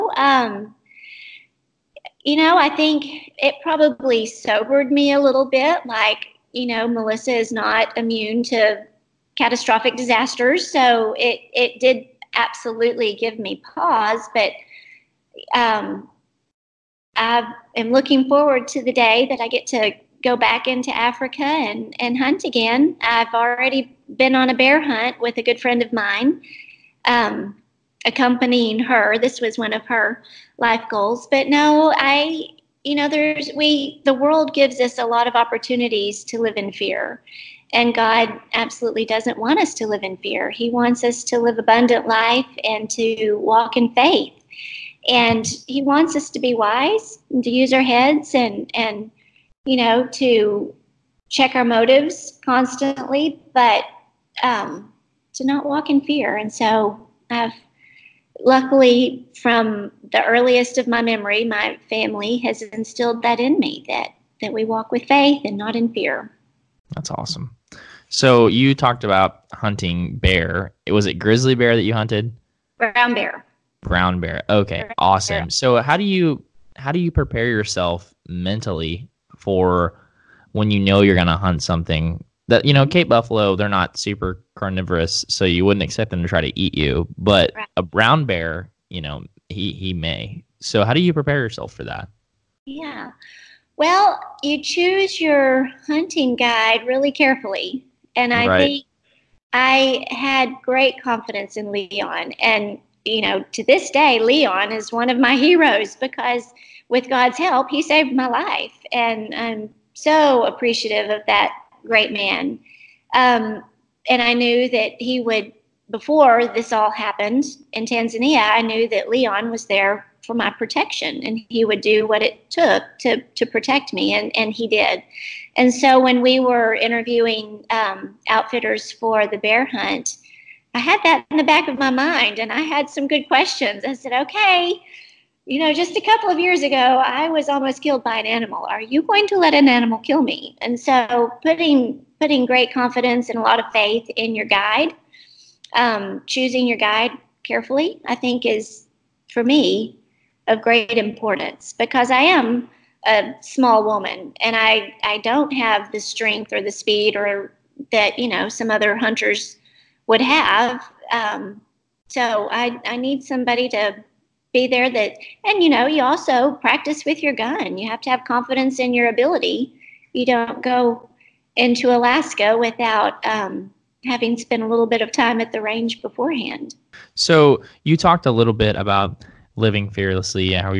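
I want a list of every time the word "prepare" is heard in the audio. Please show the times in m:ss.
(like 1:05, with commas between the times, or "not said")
1:17, 1:31.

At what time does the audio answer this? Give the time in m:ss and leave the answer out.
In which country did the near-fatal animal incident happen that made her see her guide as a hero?
1:57.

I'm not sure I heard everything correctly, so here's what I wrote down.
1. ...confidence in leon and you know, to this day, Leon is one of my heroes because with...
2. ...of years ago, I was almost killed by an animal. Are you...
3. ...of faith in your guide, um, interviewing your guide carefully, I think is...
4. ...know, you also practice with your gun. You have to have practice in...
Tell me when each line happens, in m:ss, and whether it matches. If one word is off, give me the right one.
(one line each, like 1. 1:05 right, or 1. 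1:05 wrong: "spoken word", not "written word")
1. 1:41 right
2. 2:16 right
3. 2:23 wrong: "choosing", not "interviewing"
4. 2:45 wrong: "confidence", not "practice".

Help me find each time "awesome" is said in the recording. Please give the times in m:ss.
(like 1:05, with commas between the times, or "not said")
1:07, 1:14.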